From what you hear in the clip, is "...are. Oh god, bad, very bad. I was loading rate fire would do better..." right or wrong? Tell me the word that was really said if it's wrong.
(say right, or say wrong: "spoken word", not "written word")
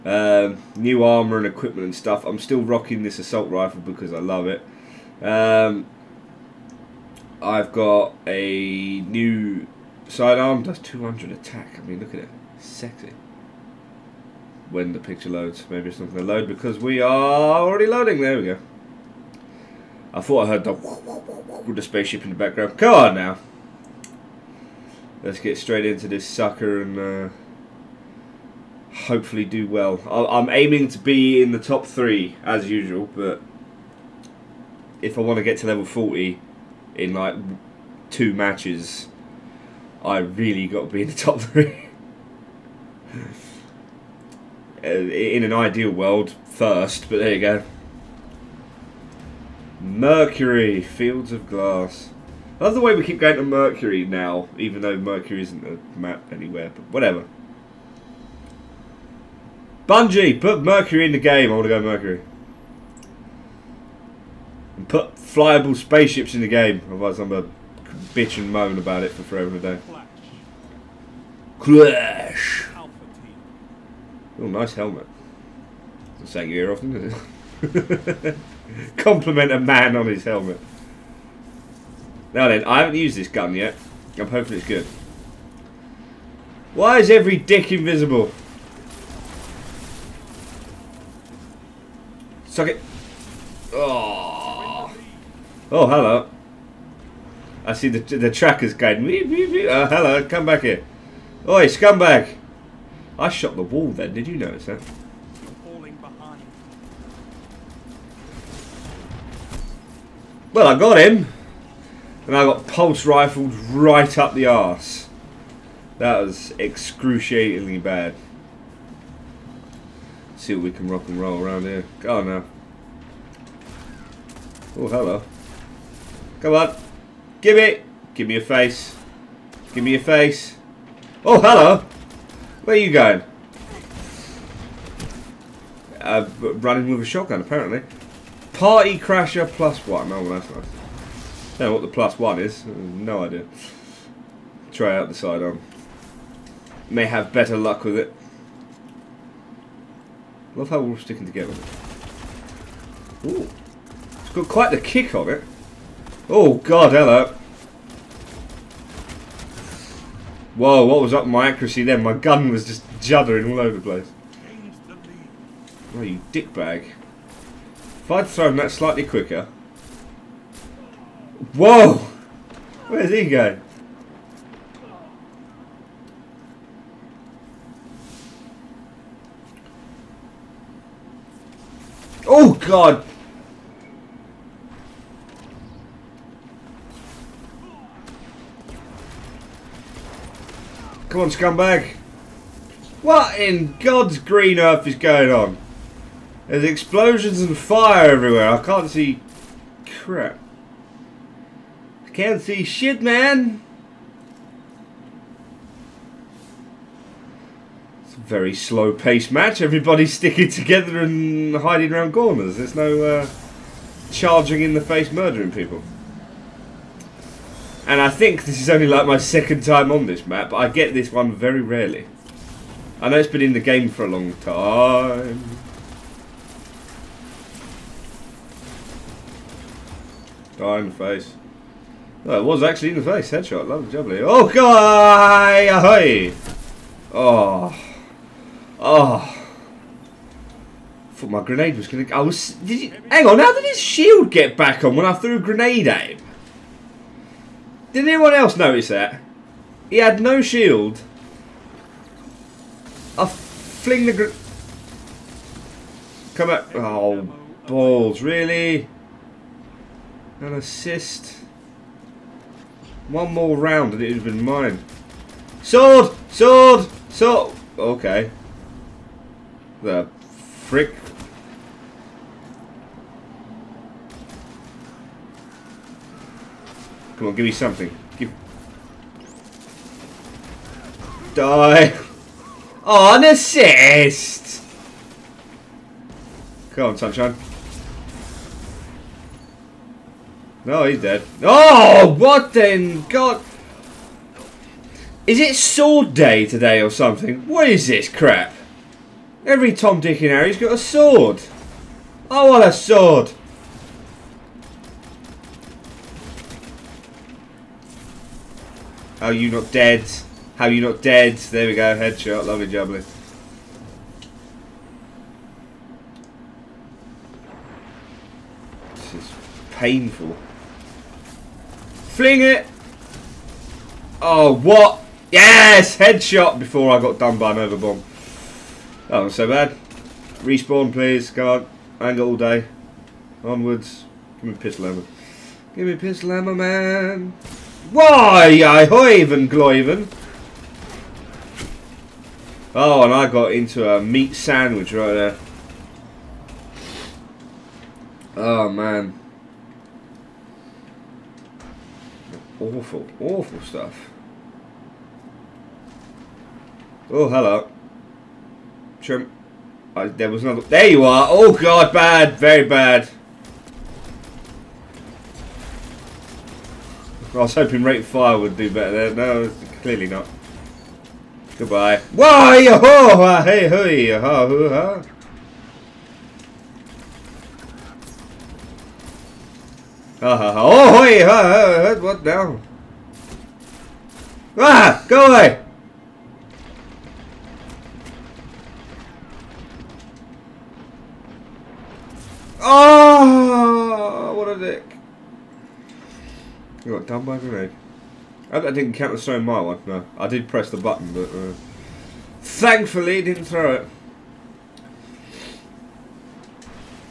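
wrong: "hoping", not "loading".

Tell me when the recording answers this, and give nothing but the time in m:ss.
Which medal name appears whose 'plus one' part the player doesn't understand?
2:18.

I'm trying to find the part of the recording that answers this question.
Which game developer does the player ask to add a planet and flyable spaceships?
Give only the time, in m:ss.
0:59.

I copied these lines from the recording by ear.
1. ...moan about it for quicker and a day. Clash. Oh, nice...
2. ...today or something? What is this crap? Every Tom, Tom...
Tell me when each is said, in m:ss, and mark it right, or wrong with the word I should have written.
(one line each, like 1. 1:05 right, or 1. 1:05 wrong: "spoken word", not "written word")
1. 1:08 wrong: "forever", not "quicker"
2. 4:56 wrong: "Dick", not "Tom".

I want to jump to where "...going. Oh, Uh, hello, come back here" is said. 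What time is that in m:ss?
1:38.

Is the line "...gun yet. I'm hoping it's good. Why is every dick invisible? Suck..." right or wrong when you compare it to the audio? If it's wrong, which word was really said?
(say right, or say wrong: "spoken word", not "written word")
right.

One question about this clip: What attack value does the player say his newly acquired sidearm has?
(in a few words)
200.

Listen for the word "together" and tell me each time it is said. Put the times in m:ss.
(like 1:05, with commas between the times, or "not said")
2:31, 3:30.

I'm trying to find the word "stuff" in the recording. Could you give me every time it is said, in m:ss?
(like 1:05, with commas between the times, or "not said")
0:01, 5:53.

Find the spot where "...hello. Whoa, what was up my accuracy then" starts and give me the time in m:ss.
2:36.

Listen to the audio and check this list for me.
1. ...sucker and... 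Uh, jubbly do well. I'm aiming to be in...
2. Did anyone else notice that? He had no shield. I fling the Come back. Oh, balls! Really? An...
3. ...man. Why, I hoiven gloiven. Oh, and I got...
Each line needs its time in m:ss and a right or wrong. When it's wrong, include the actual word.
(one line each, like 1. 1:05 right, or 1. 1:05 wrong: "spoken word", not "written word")
1. 0:26 wrong: "hopefully", not "jubbly"
2. 4:07 right
3. 5:36 right.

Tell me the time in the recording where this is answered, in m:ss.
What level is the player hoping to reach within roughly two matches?
0:35.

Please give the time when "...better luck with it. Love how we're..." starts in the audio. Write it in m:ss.
2:27.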